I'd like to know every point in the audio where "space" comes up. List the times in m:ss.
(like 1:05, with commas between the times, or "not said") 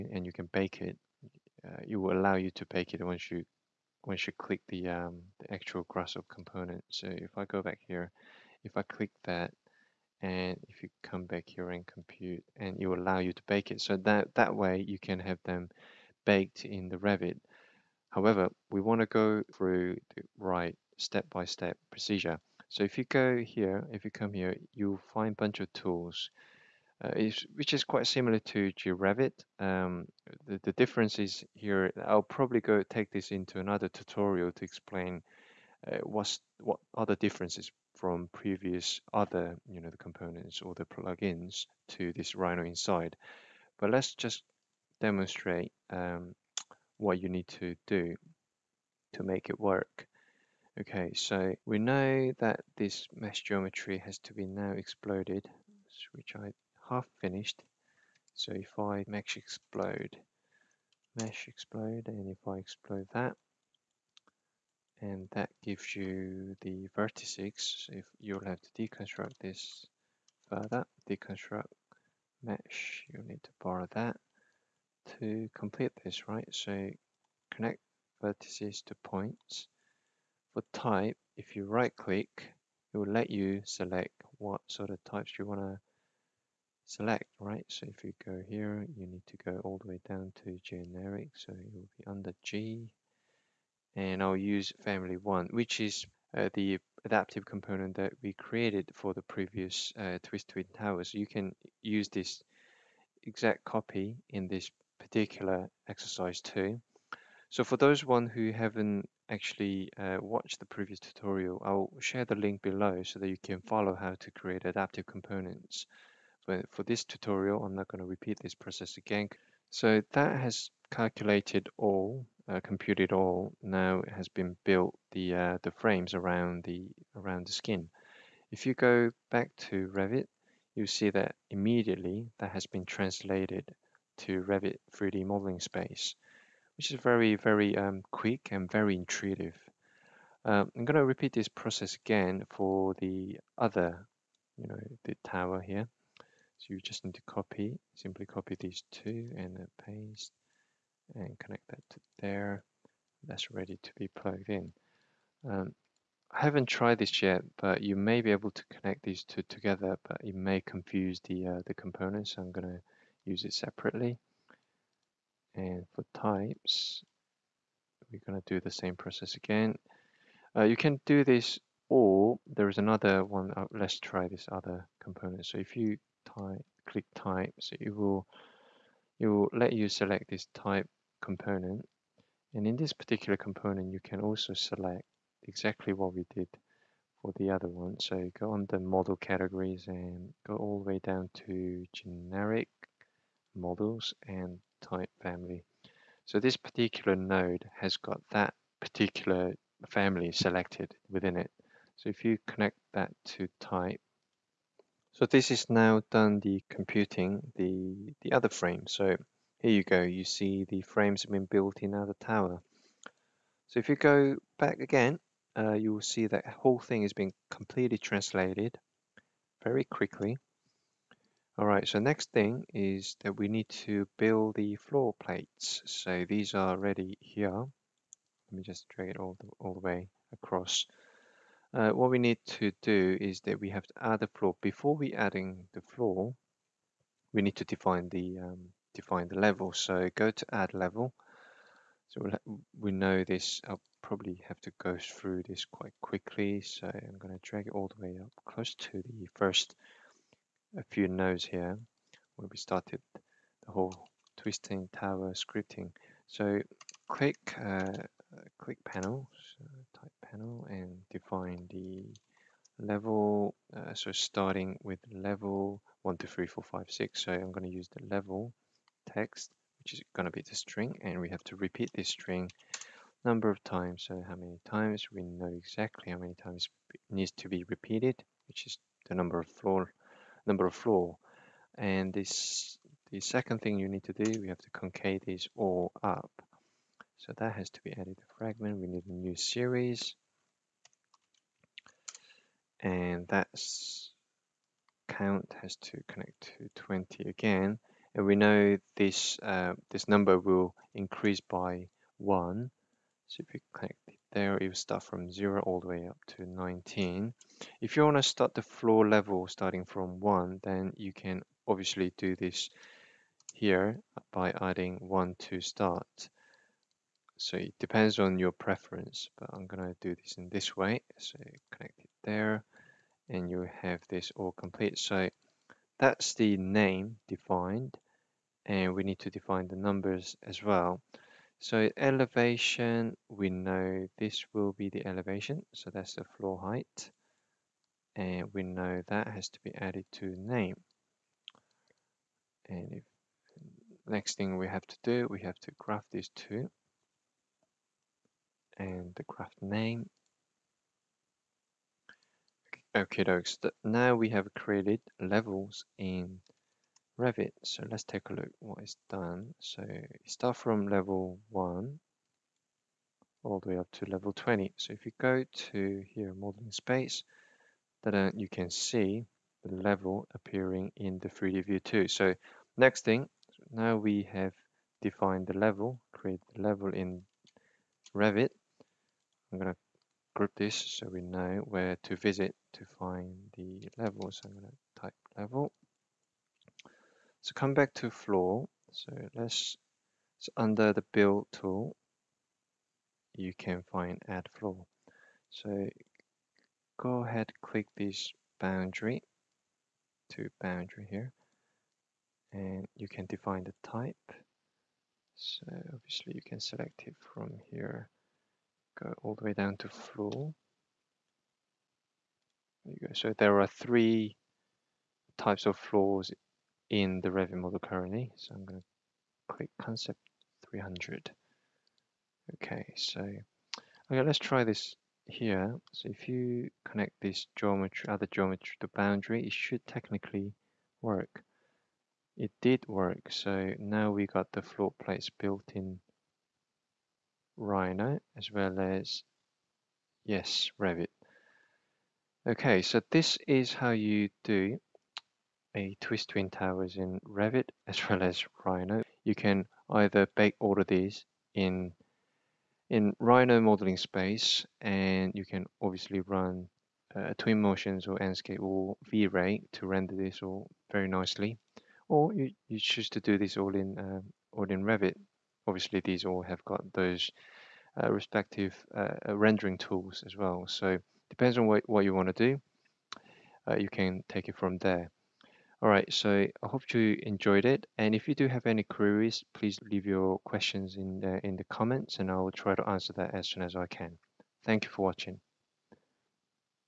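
2:15, 6:06, 7:33.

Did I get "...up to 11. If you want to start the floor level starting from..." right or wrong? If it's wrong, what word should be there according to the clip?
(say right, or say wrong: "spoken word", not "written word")
wrong: "19", not "11".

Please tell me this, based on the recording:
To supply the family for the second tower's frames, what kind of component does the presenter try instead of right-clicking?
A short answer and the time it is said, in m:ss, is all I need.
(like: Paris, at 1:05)
Type component, at 3:00.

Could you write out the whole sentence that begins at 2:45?
And for types, we're going to do the same process again.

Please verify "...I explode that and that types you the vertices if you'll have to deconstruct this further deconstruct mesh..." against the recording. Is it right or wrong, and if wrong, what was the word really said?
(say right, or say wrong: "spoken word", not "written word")
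wrong: "gives", not "types".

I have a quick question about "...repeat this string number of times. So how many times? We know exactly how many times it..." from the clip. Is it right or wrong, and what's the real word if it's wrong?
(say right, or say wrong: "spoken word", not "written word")
right.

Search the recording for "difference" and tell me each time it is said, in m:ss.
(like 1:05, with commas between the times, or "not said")
0:30, 0:37.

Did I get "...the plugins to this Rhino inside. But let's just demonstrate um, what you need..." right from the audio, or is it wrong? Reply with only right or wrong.
right.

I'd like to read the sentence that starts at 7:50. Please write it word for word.
So depends on what, what you want to do.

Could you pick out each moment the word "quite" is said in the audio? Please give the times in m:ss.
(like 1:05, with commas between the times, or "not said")
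0:27, 4:05.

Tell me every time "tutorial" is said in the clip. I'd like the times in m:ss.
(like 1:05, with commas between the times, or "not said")
0:33, 1:50, 1:57.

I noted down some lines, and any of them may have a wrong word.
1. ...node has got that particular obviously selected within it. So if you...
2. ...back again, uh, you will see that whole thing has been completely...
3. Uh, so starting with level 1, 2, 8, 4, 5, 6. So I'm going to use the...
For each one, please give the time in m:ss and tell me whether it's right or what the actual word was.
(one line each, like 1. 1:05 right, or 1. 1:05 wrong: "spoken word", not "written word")
1. 3:17 wrong: "family", not "obviously"
2. 3:34 right
3. 4:23 wrong: "3", not "8".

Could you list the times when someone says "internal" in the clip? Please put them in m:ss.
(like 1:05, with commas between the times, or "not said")
not said.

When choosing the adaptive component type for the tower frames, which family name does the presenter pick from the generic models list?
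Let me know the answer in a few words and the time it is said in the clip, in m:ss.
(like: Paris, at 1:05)
Family 1, at 1:34.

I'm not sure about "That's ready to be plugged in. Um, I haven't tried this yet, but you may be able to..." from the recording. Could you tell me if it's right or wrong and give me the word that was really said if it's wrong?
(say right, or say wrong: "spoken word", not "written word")
right.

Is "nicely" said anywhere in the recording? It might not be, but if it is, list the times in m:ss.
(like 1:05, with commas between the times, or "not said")
7:41.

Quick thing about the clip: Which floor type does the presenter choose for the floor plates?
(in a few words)
Concept 300.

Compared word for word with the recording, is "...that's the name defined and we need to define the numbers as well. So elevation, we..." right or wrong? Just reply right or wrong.
right.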